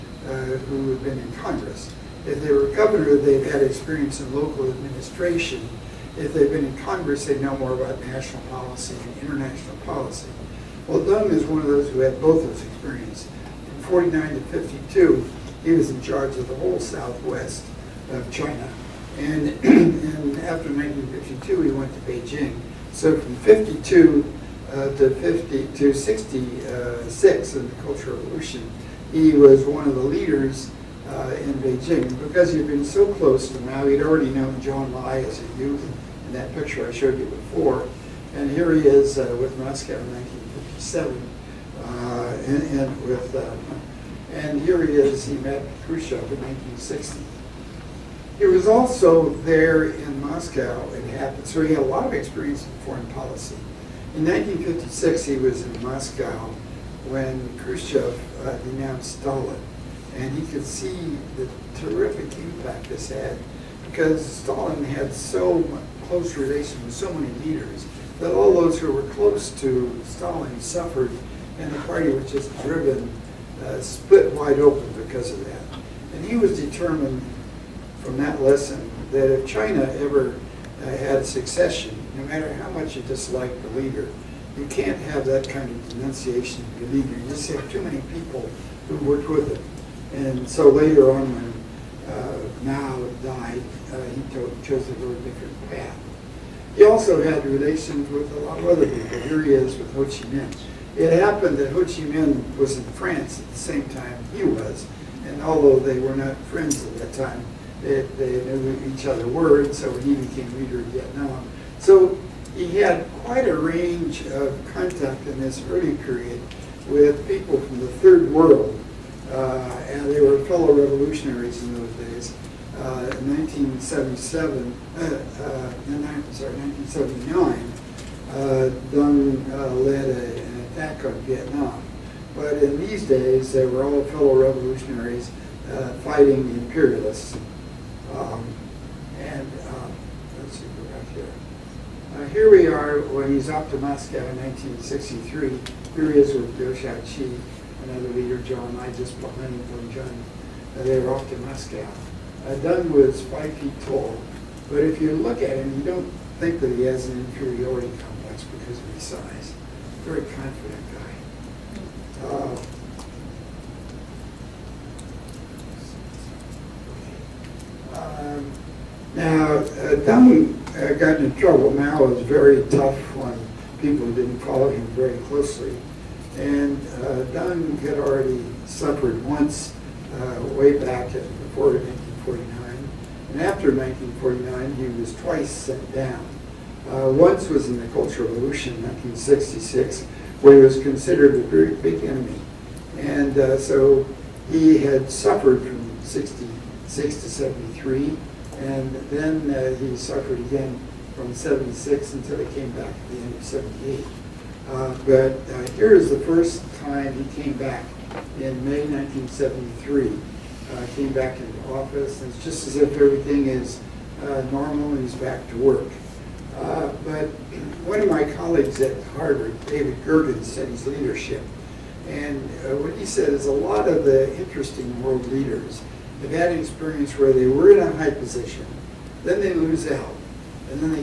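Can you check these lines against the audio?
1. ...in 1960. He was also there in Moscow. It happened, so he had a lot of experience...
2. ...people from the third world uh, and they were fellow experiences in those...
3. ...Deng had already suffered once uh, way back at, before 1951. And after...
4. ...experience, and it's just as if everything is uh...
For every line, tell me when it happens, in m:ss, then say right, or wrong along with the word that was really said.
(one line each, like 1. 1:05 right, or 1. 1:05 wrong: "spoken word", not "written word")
1. 0:46 right
2. 1:57 wrong: "revolutionaries", not "experiences"
3. 2:57 wrong: "1949", not "1951"
4. 3:31 wrong: "office", not "experience".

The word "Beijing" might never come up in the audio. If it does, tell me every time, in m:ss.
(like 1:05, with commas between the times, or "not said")
0:22, 0:31.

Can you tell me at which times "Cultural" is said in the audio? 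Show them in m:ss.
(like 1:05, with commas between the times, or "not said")
0:27, 3:07.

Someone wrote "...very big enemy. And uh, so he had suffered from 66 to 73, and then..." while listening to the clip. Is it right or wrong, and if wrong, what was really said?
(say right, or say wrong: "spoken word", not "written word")
right.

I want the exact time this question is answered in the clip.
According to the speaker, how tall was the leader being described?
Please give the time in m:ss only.
2:33.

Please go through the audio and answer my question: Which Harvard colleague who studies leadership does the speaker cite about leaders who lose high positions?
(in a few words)
David Gergen.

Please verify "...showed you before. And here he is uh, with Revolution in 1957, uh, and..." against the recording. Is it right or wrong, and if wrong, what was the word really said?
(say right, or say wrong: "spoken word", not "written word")
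wrong: "Moscow", not "Revolution".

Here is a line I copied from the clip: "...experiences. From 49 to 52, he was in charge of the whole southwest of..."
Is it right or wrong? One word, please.
right.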